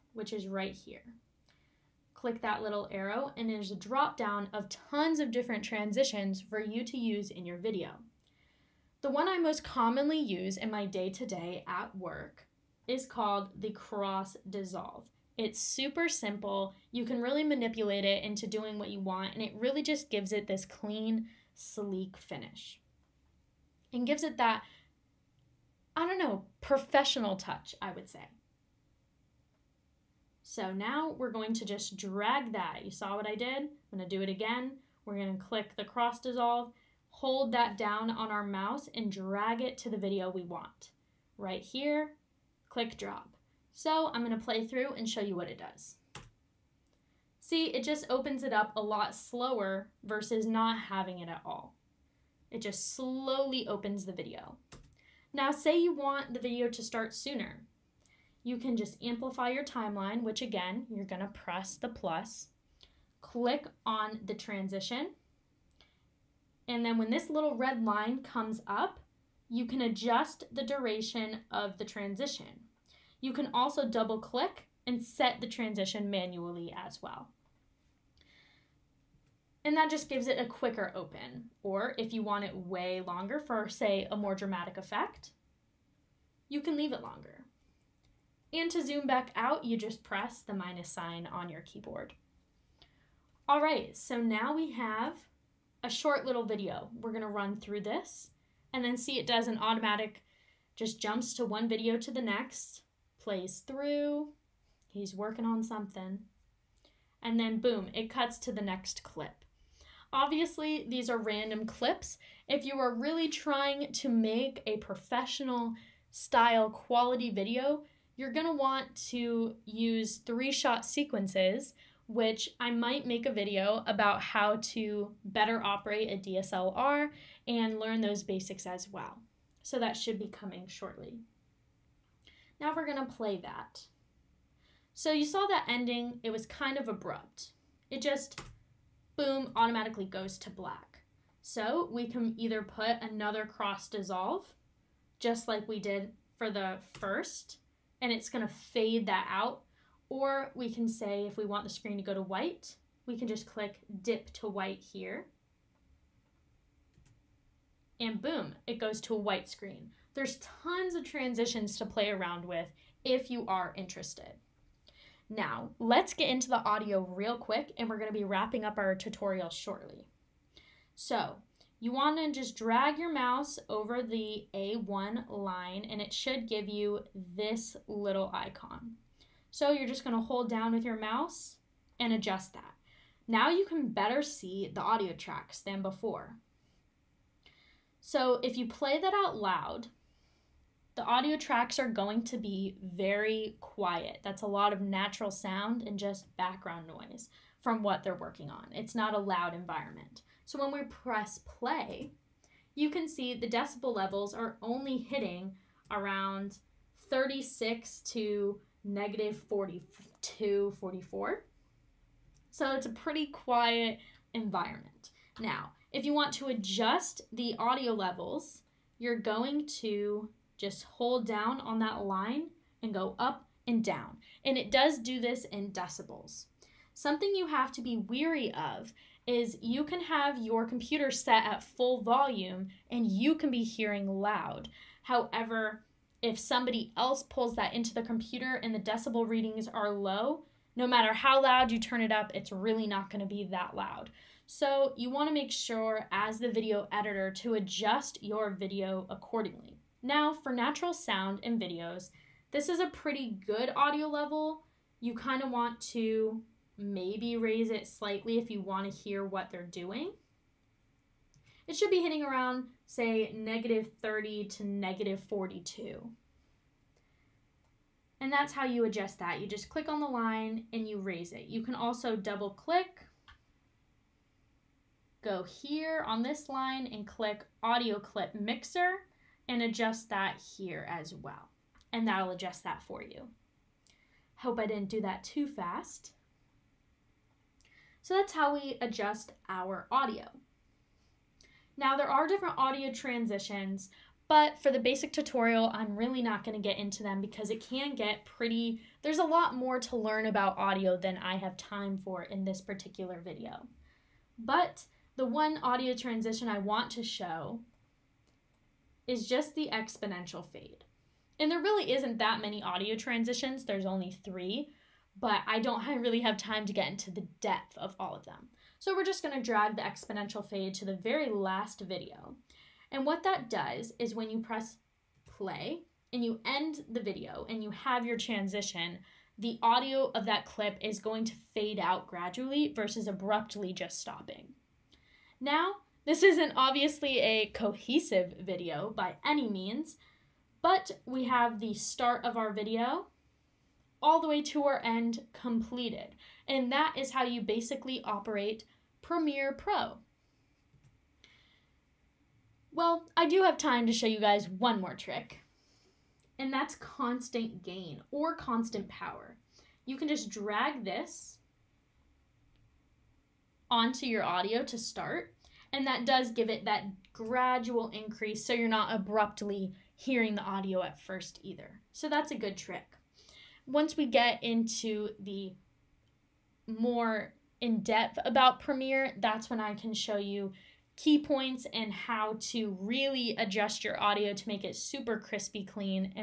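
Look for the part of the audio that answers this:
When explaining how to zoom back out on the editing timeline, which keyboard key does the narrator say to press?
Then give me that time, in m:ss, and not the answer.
1:30.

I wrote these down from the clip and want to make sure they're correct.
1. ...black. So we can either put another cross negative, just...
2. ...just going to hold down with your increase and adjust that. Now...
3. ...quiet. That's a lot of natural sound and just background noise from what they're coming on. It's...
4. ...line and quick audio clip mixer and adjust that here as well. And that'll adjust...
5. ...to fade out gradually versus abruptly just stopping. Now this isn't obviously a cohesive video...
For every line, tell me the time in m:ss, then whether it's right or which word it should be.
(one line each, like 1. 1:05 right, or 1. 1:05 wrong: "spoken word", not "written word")
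1. 2:20 wrong: "dissolve", not "negative"
2. 2:59 wrong: "mouse", not "increase"
3. 3:13 wrong: "working", not "coming"
4. 4:36 wrong: "click", not "quick"
5. 5:31 right.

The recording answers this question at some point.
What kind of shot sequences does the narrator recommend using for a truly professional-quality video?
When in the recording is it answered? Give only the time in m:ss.
2:00.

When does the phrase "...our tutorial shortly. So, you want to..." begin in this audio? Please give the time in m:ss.
2:48.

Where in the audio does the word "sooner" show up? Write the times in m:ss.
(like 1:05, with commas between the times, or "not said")
0:57.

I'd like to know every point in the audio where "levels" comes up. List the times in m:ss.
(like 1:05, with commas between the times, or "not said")
3:23, 3:37, 4:14.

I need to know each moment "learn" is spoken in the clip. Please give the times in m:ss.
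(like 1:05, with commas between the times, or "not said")
2:07, 4:59.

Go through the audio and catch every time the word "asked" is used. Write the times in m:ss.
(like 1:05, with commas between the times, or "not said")
not said.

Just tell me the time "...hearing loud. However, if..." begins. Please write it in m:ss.
3:53.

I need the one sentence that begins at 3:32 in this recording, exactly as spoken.
So it's a pretty quiet environment.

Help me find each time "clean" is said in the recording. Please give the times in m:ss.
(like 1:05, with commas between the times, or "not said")
0:20, 6:25.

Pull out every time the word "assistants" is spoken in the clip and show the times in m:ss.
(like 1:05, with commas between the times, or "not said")
not said.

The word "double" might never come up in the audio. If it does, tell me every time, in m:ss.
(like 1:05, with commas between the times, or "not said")
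1:13, 4:32.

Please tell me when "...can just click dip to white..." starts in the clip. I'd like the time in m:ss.
2:33.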